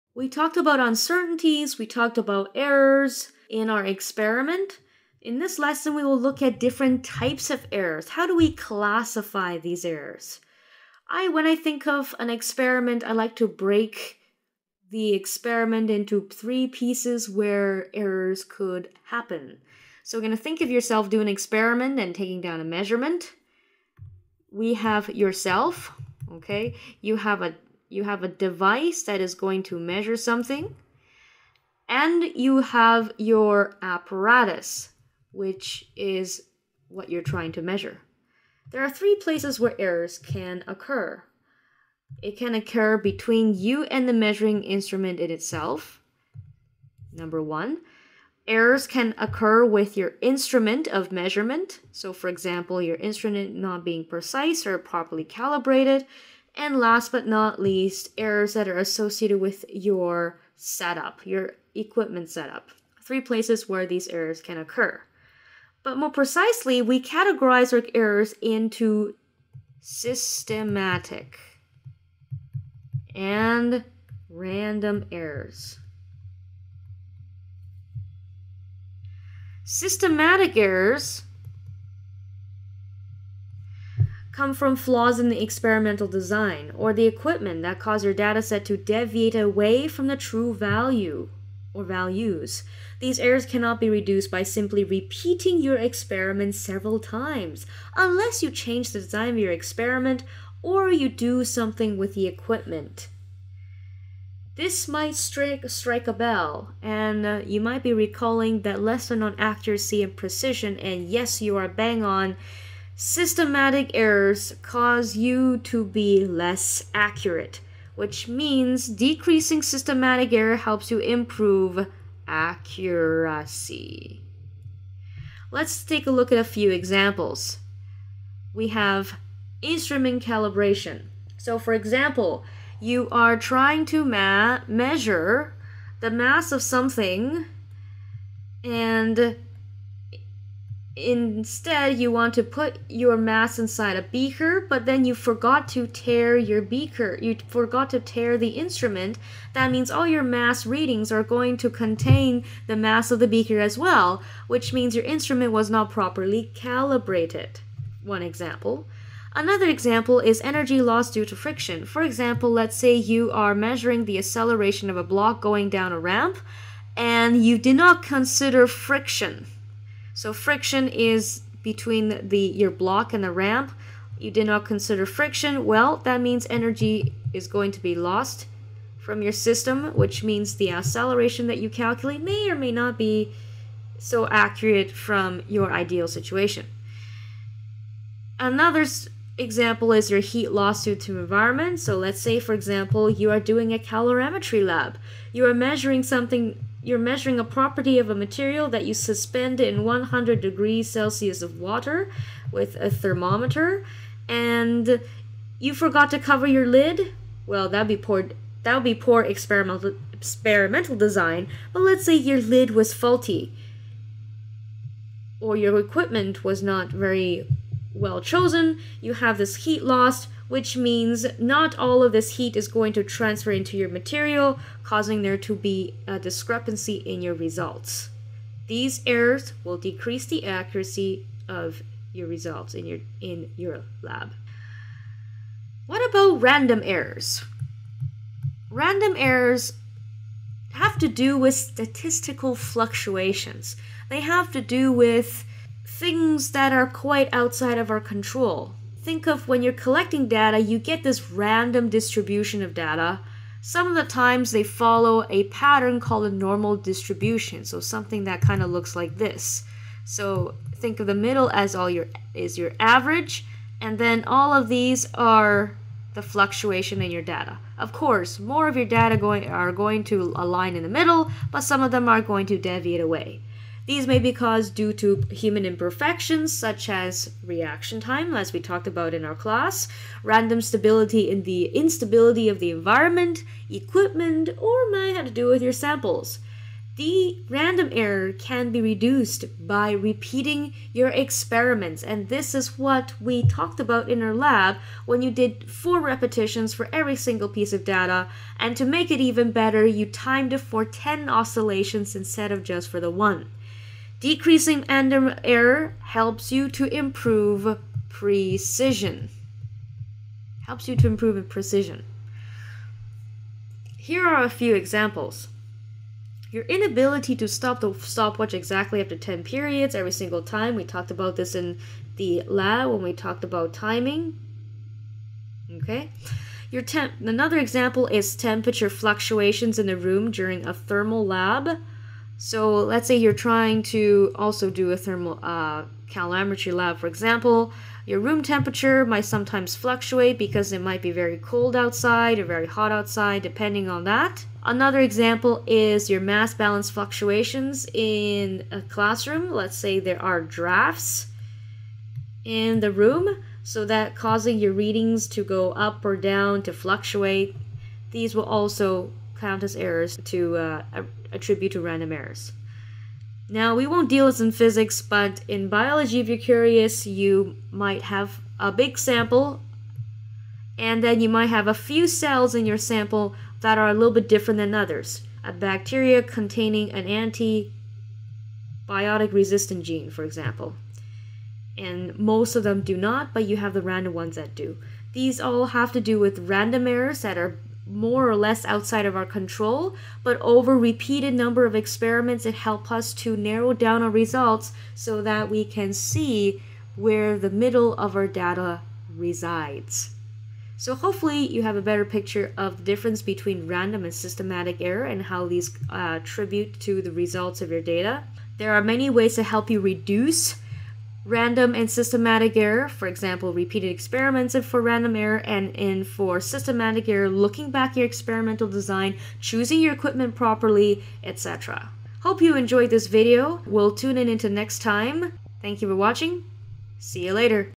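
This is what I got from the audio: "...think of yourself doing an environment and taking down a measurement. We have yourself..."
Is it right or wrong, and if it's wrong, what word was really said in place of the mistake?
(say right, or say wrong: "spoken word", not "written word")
wrong: "experiment", not "environment".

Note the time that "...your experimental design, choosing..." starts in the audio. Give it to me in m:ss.
6:57.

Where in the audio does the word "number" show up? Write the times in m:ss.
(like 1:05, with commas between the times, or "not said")
0:47, 6:31.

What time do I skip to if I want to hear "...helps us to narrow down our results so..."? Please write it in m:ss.
6:32.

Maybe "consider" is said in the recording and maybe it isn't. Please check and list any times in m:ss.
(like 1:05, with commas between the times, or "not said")
2:48, 2:54.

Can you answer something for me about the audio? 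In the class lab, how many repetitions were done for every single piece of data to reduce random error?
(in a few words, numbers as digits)
4.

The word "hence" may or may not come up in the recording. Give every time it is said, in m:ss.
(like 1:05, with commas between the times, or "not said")
not said.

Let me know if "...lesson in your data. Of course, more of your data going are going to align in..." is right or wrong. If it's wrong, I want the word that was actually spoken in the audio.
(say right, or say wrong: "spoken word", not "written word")
wrong: "fluctuation", not "lesson".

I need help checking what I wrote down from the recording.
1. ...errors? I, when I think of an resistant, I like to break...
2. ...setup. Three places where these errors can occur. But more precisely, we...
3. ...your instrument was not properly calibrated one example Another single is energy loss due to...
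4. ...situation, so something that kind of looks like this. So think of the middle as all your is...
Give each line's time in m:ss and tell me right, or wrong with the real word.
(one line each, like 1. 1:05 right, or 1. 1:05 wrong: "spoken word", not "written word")
1. 0:09 wrong: "experiment", not "resistant"
2. 1:02 right
3. 2:34 wrong: "example", not "single"
4. 4:16 wrong: "distribution", not "situation".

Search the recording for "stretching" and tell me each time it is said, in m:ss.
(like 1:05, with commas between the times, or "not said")
not said.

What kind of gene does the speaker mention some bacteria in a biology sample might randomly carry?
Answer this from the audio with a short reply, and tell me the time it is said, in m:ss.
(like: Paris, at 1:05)
Antibiotic resistant gene, at 6:17.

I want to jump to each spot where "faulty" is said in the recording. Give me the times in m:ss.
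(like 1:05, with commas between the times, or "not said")
3:32.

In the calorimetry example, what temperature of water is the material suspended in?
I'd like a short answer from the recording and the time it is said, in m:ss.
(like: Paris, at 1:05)
100 degrees Celsius, at 3:19.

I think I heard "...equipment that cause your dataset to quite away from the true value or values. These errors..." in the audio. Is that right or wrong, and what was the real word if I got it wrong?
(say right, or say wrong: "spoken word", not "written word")
wrong: "deviate", not "quite".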